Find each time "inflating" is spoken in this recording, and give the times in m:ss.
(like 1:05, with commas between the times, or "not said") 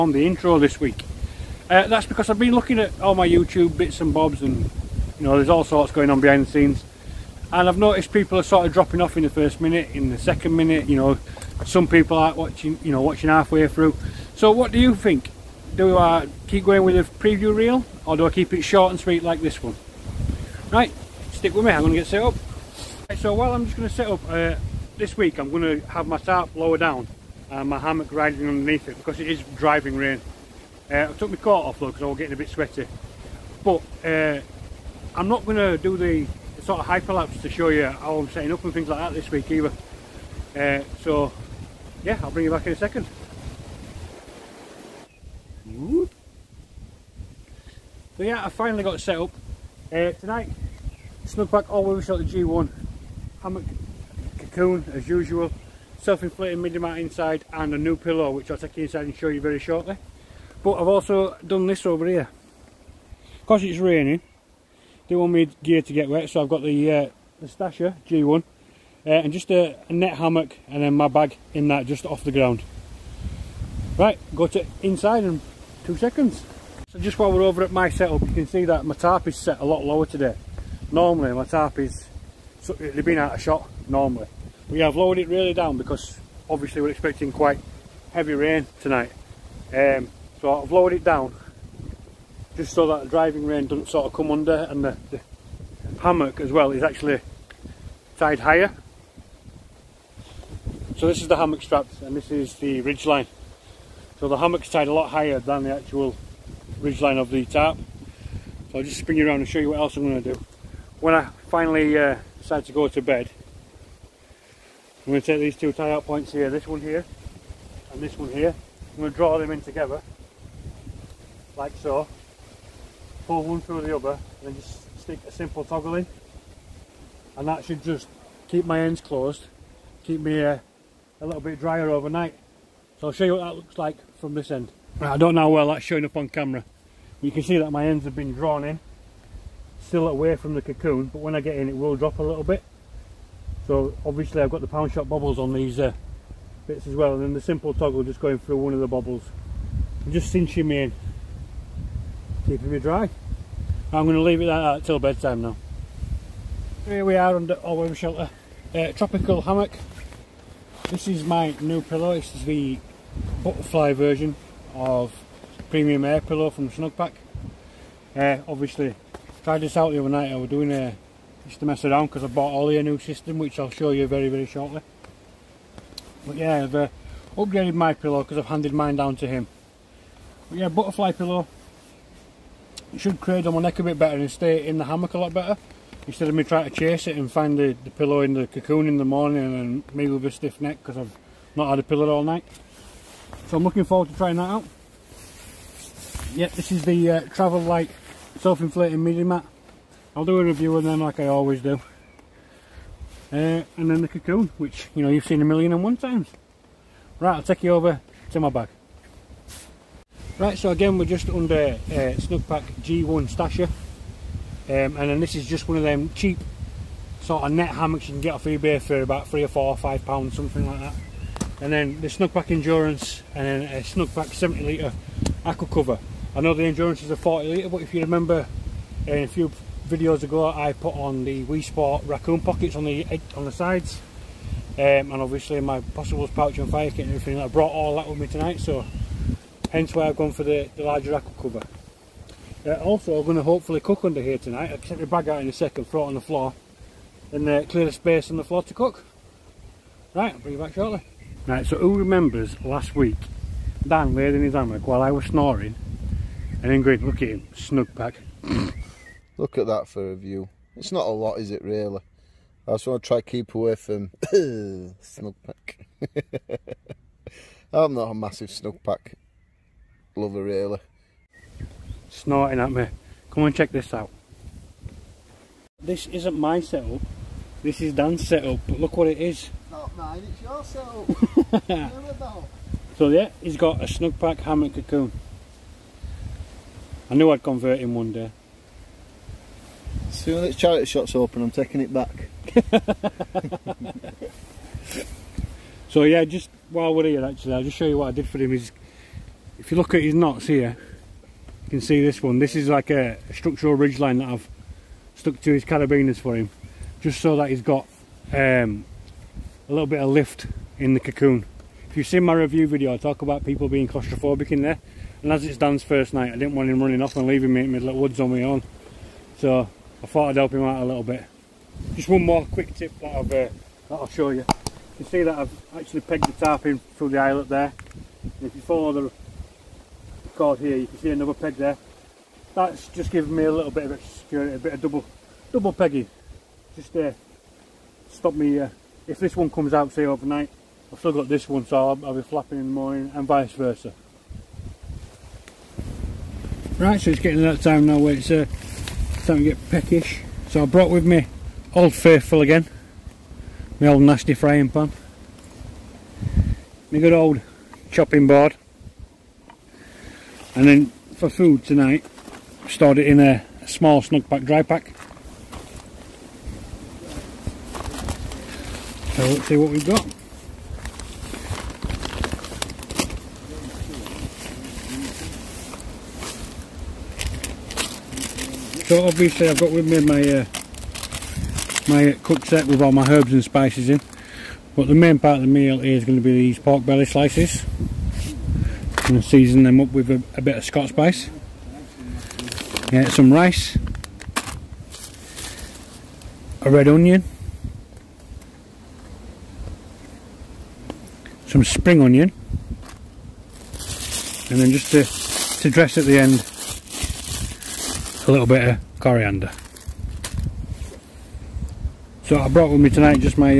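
0:56, 3:18.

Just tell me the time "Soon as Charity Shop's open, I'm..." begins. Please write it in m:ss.
4:50.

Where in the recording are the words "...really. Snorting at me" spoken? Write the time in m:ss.
4:30.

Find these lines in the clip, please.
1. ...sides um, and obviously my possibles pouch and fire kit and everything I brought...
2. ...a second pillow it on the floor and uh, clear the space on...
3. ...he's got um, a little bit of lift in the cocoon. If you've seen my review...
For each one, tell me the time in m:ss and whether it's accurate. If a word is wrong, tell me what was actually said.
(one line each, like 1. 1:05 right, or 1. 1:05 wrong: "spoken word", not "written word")
1. 3:53 right
2. 4:05 wrong: "throw", not "pillow"
3. 5:07 right.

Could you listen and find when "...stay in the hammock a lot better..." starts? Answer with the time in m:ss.
3:04.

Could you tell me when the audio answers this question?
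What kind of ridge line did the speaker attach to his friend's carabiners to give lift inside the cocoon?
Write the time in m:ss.
5:03.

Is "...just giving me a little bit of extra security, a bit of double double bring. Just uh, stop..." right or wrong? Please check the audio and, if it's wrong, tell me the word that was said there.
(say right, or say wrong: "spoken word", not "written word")
wrong: "pegging", not "bring".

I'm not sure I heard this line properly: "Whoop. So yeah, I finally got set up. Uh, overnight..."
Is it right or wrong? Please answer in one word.
wrong.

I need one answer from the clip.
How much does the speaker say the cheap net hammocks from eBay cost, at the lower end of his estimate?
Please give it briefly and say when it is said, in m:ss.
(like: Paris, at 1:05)
3 pounds, at 3:39.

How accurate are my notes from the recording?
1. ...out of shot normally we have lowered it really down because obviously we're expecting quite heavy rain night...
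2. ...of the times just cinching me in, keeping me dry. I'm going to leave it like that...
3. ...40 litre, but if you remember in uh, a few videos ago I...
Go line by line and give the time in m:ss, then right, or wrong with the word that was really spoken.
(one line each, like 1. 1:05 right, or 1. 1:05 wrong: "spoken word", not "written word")
1. 1:23 wrong: "tonight", not "night"
2. 2:28 wrong: "bobbles", not "times"
3. 3:47 right.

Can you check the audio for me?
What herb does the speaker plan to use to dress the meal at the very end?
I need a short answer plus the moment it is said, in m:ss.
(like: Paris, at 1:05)
coriander, at 6:48.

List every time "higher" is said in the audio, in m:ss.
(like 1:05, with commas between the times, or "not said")
1:38, 1:45.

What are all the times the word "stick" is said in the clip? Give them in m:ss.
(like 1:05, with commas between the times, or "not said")
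0:21, 2:05.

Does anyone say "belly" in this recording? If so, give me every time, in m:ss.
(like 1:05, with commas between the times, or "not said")
6:26.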